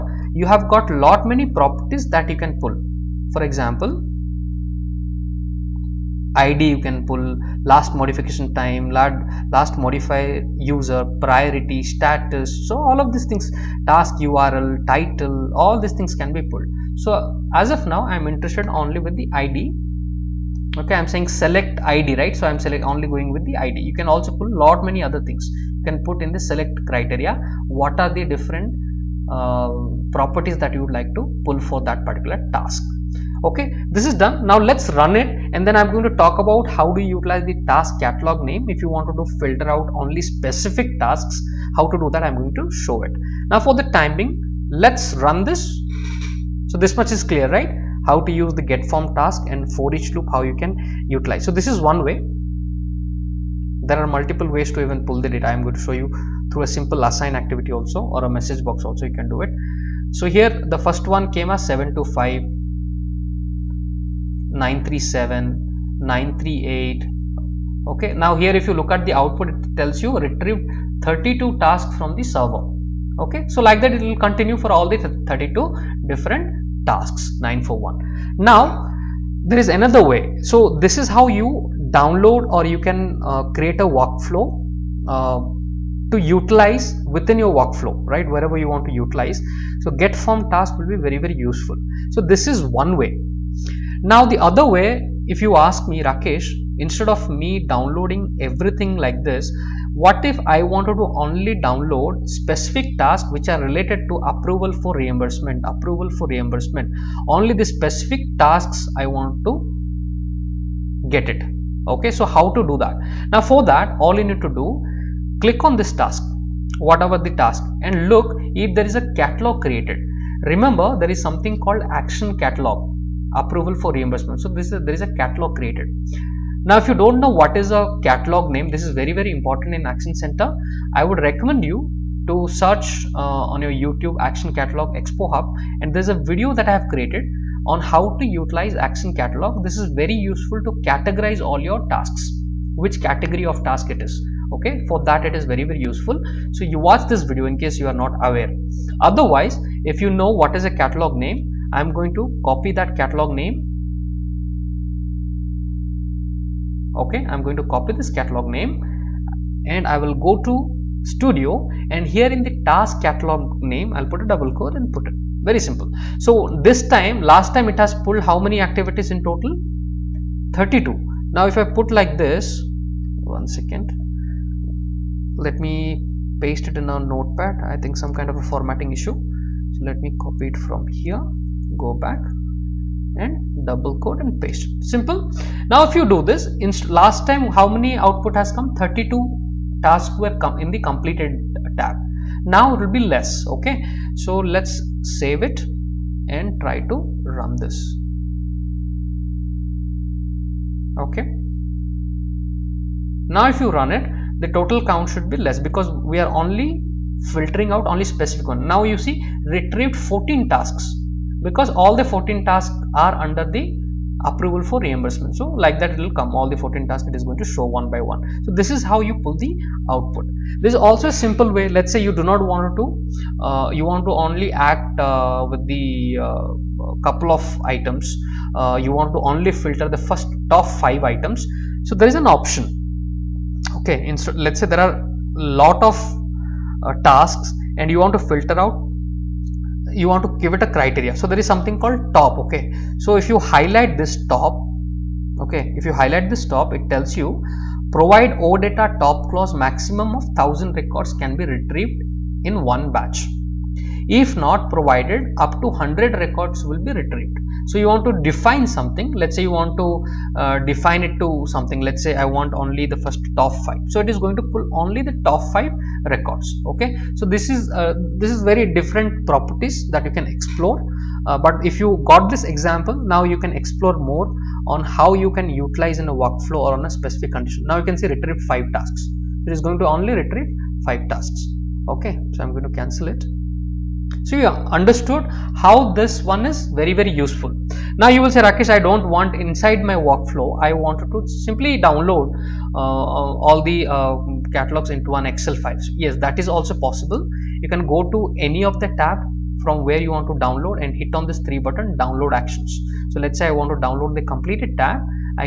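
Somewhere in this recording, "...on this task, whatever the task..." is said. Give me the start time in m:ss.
1:55.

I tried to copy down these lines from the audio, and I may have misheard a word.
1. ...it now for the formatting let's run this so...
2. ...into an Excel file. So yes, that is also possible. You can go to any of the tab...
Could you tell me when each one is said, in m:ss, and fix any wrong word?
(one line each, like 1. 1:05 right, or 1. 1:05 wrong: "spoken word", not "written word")
1. 0:43 wrong: "timing", not "formatting"
2. 4:54 right.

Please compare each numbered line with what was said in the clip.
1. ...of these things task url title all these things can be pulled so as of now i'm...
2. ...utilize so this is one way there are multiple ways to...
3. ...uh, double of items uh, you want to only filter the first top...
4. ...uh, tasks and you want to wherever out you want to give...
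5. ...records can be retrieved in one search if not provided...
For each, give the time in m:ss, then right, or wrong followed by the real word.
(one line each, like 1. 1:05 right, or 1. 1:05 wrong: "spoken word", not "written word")
1. 0:13 right
2. 0:51 right
3. 3:46 wrong: "couple", not "double"
4. 3:56 wrong: "filter", not "wherever"
5. 4:10 wrong: "batch", not "search".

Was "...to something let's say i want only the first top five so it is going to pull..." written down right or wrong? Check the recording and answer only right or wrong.
right.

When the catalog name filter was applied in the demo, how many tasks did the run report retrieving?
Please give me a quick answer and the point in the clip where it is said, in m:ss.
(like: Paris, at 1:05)
14, at 3:29.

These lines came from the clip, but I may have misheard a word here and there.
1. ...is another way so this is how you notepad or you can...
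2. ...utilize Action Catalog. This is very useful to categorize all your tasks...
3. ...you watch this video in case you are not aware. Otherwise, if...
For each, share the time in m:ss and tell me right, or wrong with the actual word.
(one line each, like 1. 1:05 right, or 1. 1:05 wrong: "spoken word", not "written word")
1. 1:19 wrong: "download", not "notepad"
2. 2:18 right
3. 2:26 right.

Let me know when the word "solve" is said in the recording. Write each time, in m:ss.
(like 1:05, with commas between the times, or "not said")
not said.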